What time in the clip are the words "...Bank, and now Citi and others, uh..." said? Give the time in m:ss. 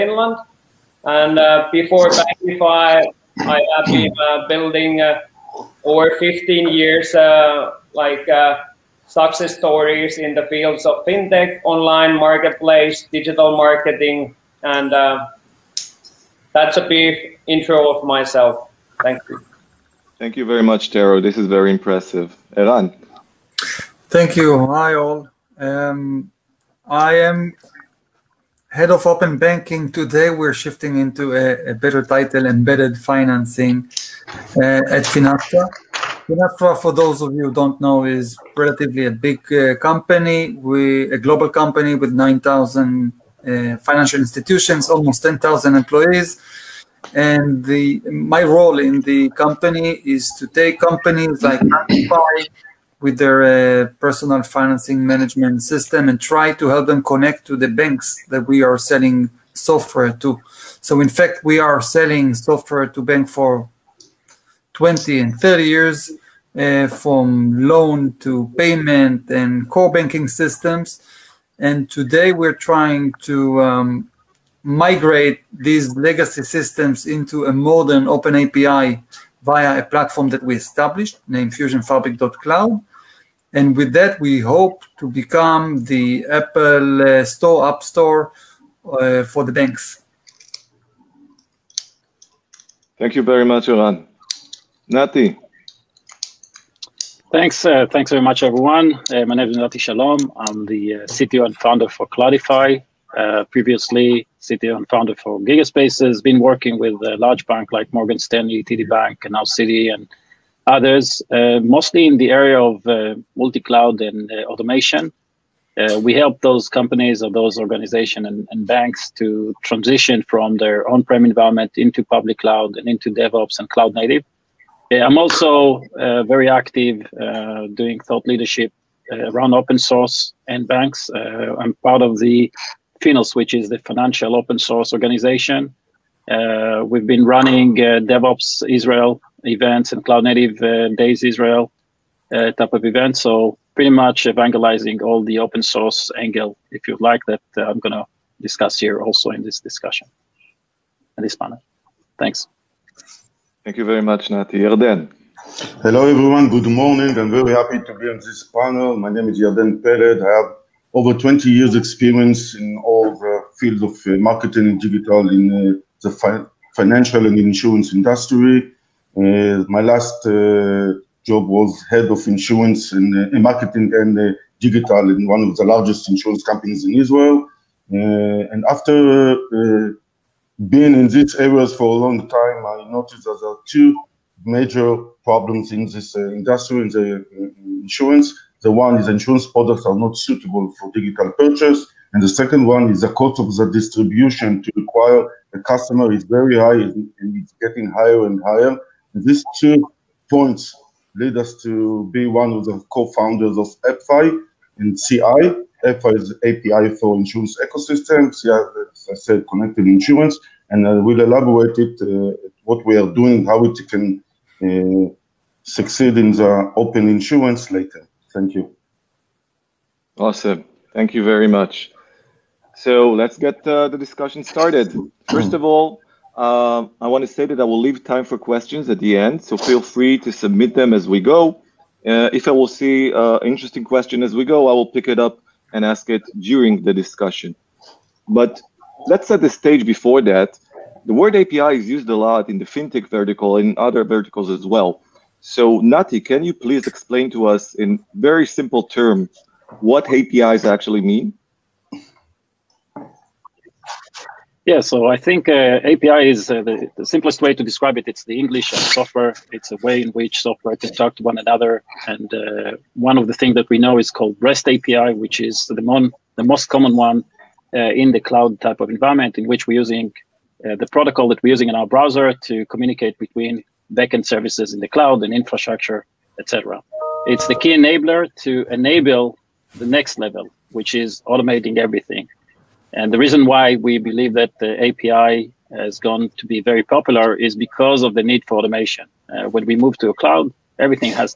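1:48.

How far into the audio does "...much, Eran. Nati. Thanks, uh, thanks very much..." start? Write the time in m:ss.
1:33.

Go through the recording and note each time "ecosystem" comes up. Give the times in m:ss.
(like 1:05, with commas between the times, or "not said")
3:27.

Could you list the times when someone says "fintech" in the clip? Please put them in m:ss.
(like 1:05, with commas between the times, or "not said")
0:11, 4:02.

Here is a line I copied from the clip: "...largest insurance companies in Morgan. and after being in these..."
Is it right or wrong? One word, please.
wrong.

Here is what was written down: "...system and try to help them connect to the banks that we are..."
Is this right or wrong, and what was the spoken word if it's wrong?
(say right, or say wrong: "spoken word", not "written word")
right.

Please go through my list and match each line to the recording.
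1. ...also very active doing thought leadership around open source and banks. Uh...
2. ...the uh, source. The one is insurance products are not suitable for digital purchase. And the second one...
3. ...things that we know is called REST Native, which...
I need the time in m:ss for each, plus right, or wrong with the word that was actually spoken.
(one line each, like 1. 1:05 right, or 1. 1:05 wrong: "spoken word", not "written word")
1. 2:05 right
2. 3:06 wrong: "insurance", not "source"
3. 4:23 wrong: "API", not "Native".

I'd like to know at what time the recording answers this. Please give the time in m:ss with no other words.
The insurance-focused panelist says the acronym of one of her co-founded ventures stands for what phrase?
3:29.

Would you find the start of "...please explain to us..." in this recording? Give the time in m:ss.
4:06.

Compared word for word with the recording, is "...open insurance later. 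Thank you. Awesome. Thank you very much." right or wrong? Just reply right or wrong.
right.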